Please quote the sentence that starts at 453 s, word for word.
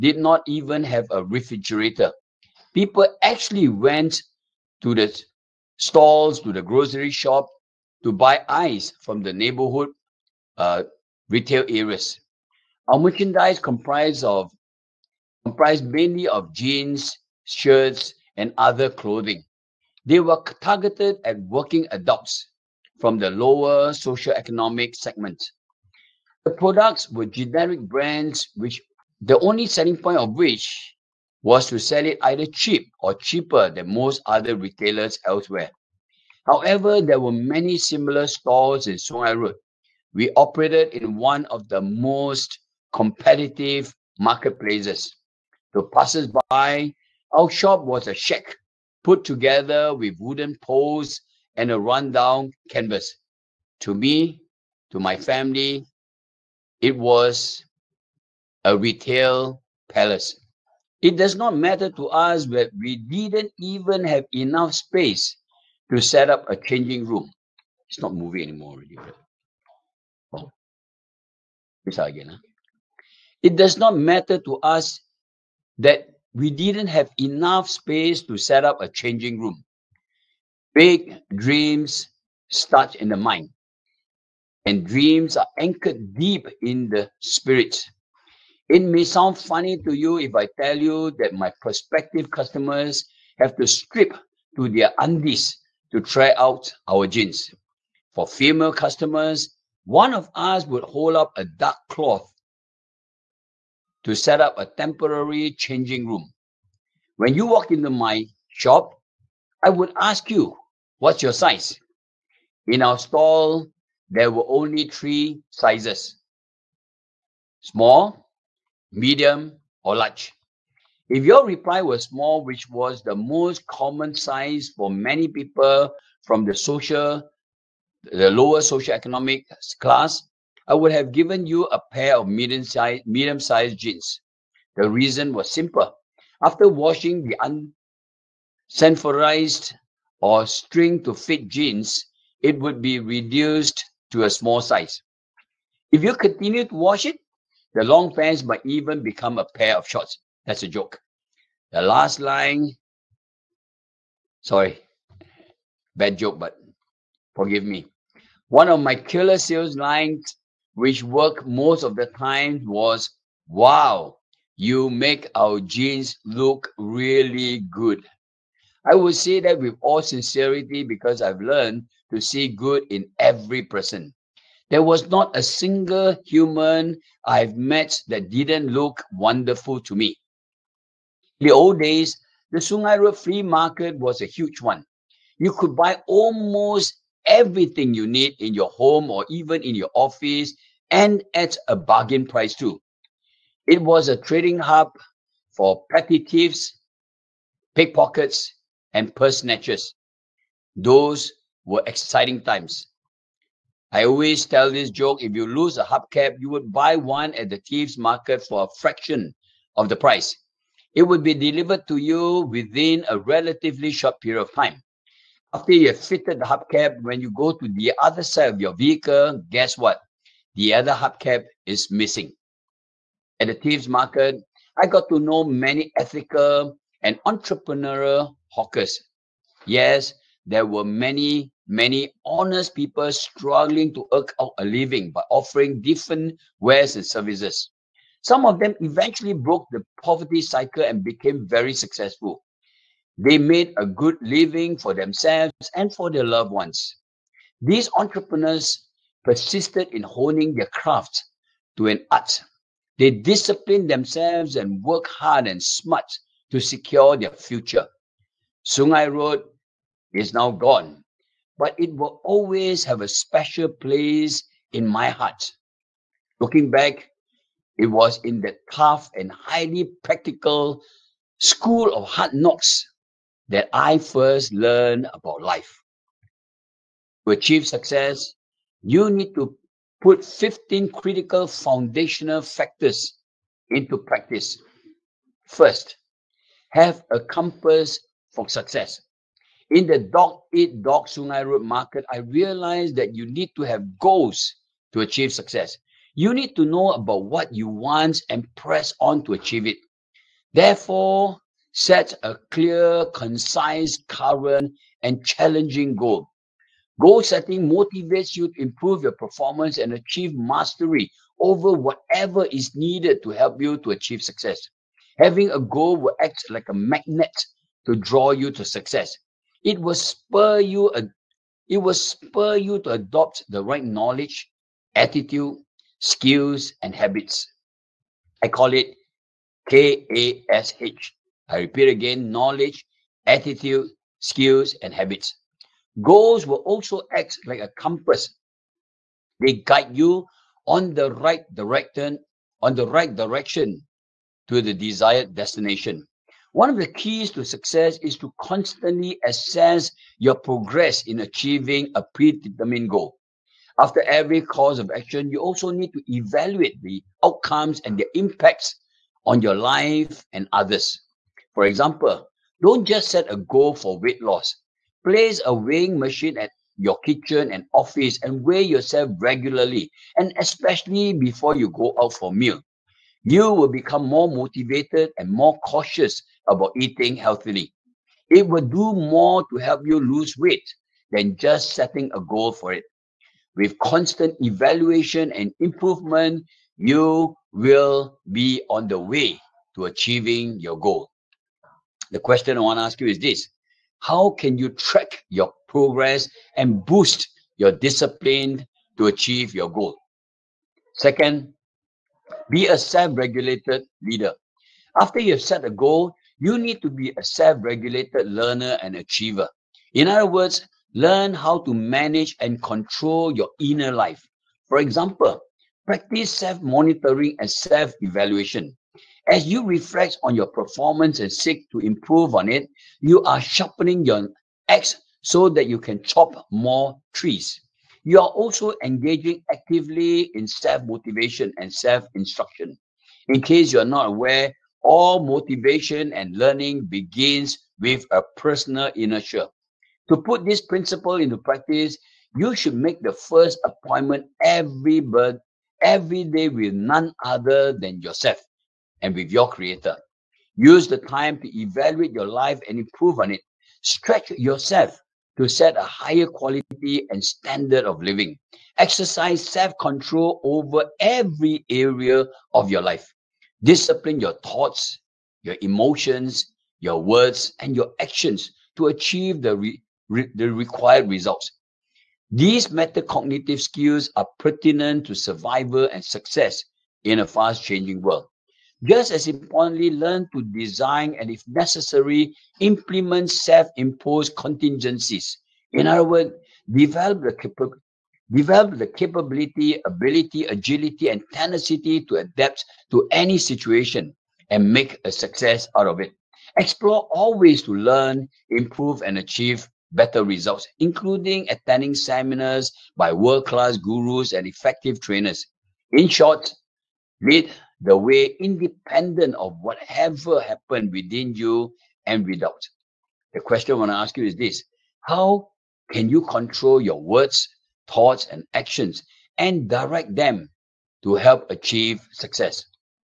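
Stretch yourself to set a higher quality and standard of living.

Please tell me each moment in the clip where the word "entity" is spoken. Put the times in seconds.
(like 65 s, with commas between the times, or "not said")
not said.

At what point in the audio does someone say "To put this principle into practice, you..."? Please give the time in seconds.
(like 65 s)
440 s.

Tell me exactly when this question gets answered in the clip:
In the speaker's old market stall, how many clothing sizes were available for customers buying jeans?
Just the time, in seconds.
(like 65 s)
114 s.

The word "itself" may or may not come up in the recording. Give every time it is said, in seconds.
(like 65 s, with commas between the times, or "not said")
not said.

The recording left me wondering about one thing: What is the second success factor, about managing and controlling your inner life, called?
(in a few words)
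self regulated leader.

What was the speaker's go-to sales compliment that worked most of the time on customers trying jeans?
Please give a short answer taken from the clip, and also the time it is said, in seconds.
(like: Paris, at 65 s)
You make our jeans look really good, at 164 s.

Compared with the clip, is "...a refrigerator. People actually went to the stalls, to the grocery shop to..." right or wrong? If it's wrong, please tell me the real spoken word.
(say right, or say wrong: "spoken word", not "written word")
right.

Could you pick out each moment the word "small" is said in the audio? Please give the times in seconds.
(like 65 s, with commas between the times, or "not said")
117 s, 122 s, 144 s.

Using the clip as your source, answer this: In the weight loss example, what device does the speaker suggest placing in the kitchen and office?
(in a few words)
weighing machine.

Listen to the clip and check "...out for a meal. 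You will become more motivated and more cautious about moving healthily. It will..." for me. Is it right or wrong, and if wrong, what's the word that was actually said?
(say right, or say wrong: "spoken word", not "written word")
wrong: "eating", not "moving".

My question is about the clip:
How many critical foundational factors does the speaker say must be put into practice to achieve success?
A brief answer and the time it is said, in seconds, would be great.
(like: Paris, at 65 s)
15, at 280 s.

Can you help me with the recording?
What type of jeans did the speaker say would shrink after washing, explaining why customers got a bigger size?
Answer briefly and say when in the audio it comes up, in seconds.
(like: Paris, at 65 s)
unsanforized, at 138 s.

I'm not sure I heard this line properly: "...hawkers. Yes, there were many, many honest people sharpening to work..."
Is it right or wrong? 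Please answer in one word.
wrong.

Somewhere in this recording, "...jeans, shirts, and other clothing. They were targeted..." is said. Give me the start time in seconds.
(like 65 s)
16 s.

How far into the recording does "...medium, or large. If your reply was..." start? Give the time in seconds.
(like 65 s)
118 s.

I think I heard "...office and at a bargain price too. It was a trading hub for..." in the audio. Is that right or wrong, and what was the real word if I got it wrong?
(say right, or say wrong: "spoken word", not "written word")
right.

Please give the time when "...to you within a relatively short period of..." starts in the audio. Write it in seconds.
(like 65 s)
211 s.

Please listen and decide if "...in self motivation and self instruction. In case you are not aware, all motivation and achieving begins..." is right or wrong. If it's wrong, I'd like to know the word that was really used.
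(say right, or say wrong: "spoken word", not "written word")
wrong: "learning", not "achieving".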